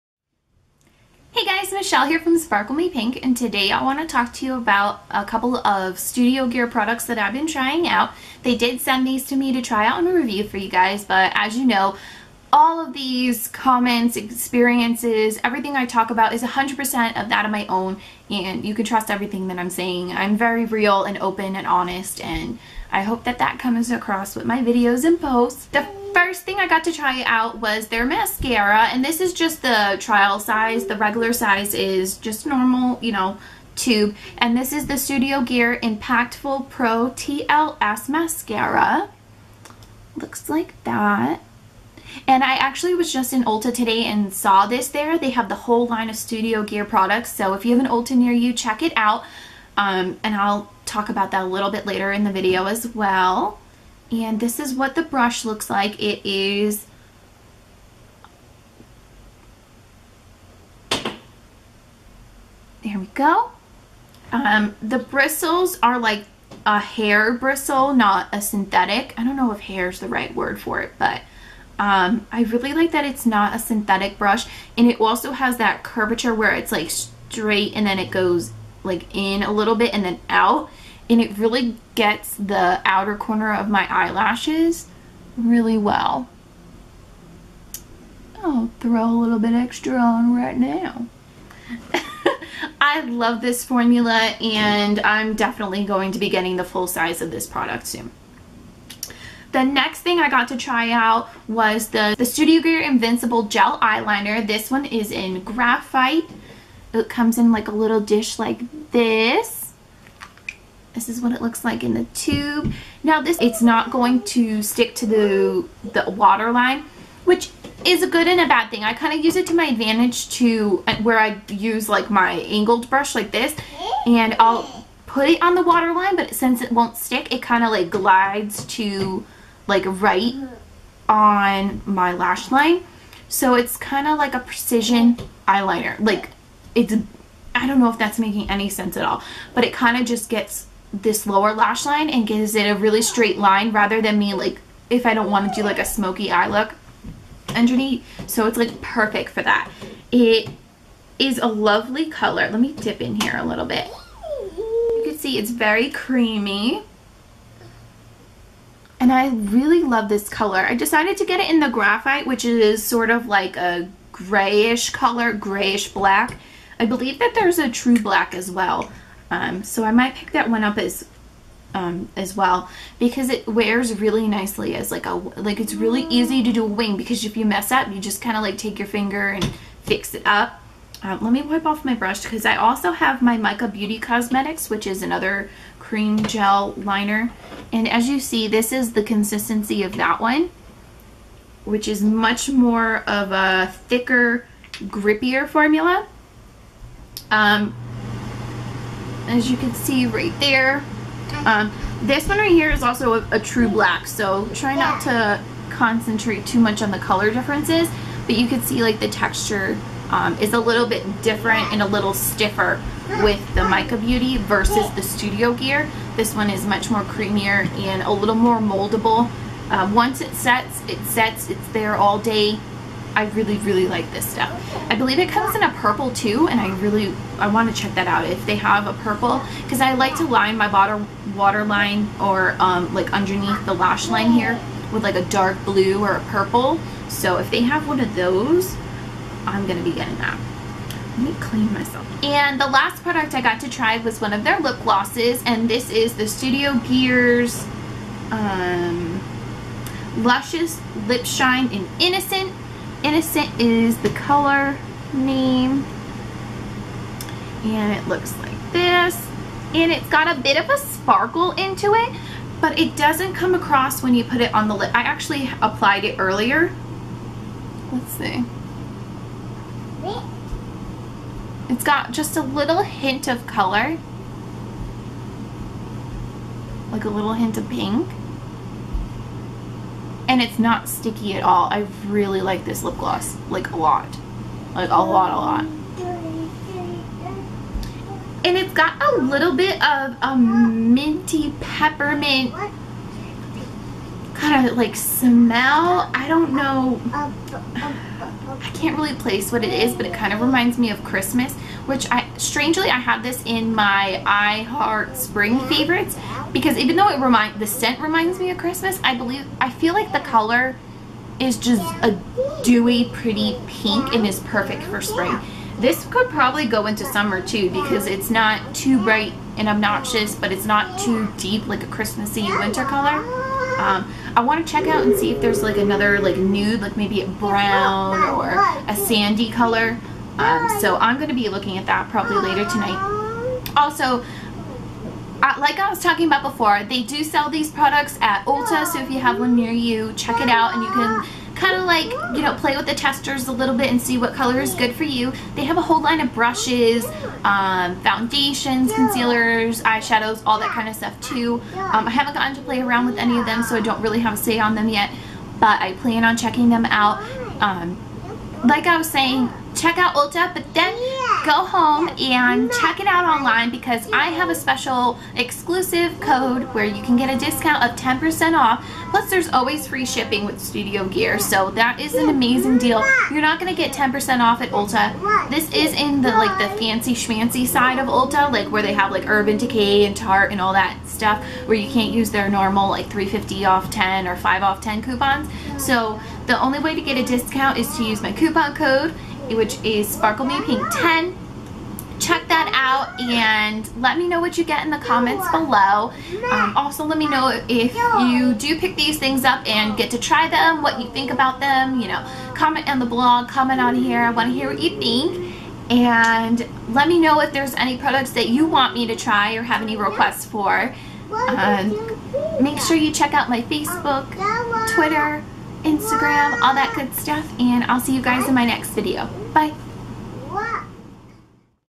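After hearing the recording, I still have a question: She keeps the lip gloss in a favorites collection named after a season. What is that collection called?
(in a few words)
I Heart Spring.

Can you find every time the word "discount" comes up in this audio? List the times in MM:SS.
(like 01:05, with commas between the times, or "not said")
06:07, 06:27.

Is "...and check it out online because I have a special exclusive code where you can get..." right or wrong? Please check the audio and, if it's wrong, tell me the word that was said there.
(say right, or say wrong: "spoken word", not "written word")
right.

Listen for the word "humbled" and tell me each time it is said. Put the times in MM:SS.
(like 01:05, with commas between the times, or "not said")
not said.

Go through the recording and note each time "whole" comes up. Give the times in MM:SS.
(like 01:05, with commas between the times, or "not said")
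00:45, 05:45.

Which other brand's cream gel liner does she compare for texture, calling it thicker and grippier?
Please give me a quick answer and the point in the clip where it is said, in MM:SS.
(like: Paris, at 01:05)
Mica Beauty Cosmetics, at 03:03.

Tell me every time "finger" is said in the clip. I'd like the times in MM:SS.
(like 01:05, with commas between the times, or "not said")
02:58.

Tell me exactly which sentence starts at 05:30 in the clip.
Um, so I'm going to be looking at that probably later tonight.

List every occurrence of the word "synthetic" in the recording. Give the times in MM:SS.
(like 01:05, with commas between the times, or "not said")
01:08, 01:13.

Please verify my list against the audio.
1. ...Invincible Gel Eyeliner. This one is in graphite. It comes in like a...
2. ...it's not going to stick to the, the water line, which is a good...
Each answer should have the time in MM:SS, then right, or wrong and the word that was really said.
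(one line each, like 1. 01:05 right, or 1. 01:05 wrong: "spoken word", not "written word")
1. 01:42 right
2. 01:53 right.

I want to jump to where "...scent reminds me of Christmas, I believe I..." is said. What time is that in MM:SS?
05:07.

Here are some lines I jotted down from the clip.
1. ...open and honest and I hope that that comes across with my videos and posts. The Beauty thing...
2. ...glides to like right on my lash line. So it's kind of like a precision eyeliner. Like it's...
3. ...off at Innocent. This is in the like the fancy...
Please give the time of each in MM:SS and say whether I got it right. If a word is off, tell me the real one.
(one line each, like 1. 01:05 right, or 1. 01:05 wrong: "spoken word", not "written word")
1. 00:21 wrong: "First", not "Beauty"
2. 02:07 right
3. 06:14 wrong: "Ulta", not "Innocent".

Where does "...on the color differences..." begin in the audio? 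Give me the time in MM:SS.
03:26.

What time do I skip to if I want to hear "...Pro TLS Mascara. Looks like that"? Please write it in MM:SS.
00:36.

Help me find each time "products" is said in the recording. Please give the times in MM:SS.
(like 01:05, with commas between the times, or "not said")
00:06, 00:46, 01:37, 04:03, 05:37, 06:47.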